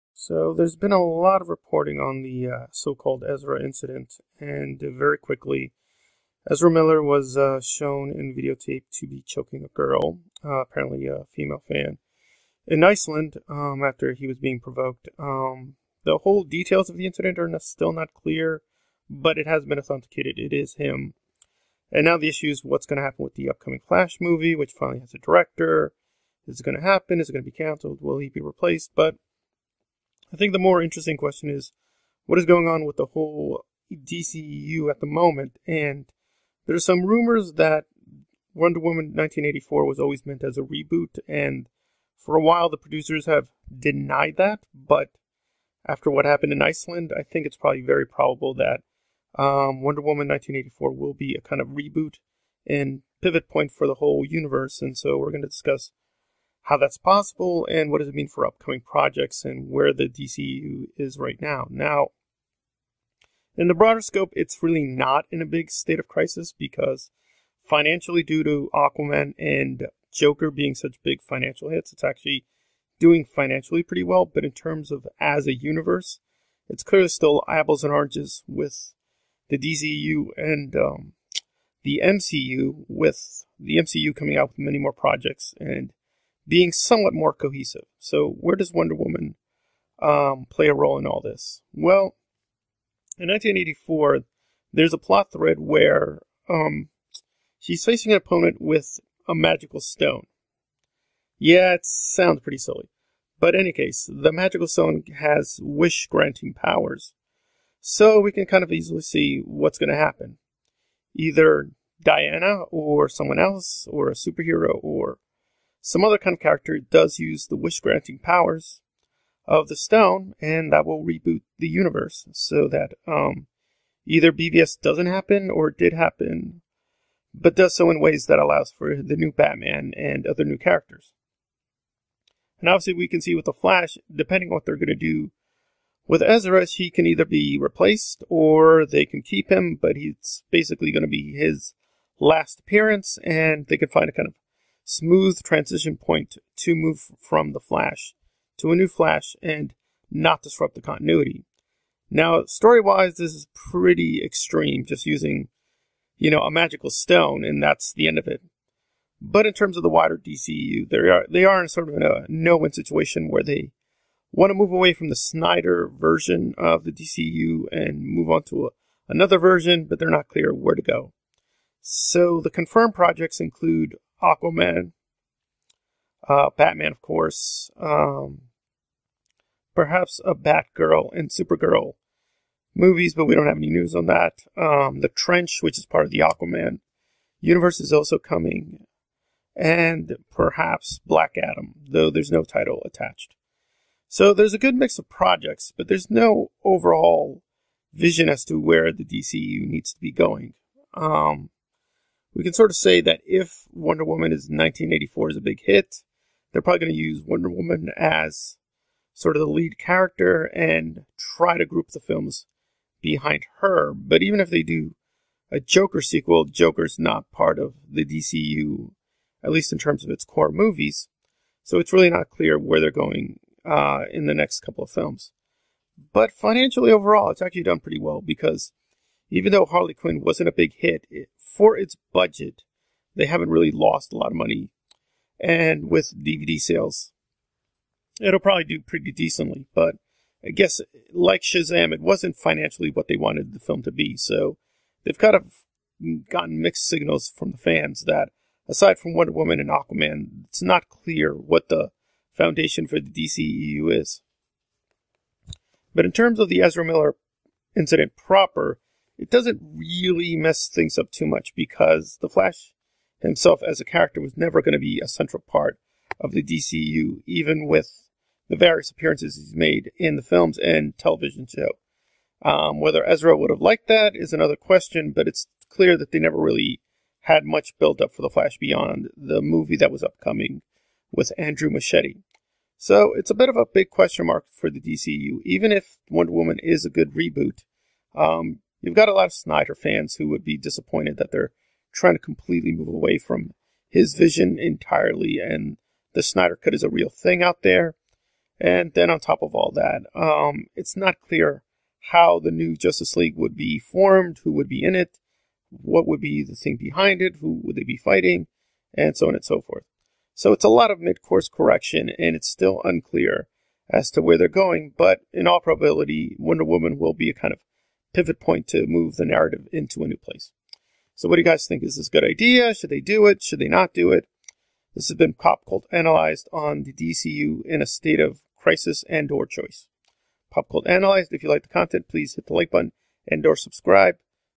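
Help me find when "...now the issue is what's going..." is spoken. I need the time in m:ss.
0:22.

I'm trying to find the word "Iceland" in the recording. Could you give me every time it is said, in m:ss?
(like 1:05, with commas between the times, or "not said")
0:12, 0:46.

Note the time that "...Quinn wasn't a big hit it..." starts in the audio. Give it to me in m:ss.
3:49.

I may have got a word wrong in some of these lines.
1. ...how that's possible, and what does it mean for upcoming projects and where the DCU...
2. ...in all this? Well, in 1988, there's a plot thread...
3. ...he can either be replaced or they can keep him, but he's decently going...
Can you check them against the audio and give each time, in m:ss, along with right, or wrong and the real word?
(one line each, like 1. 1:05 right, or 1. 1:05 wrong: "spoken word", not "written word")
1. 0:56 right
2. 1:30 wrong: "1984", not "1988"
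3. 2:16 wrong: "basically", not "decently".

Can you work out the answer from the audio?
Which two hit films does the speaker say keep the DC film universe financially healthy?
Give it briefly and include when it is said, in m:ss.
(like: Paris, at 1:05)
Aquaman and Joker, at 1:08.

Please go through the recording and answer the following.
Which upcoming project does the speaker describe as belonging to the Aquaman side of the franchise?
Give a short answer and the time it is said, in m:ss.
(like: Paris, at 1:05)
The Trench, at 3:05.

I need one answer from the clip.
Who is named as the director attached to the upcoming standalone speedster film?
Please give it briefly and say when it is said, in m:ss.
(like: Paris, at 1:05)
Andrew Muschietti, at 4:41.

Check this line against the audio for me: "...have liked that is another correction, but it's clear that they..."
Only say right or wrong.
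wrong.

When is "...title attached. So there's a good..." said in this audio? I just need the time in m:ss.
3:12.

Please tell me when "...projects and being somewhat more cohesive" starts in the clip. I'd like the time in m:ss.
1:24.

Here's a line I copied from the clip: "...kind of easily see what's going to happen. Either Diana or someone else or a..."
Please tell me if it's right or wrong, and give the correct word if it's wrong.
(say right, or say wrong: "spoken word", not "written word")
right.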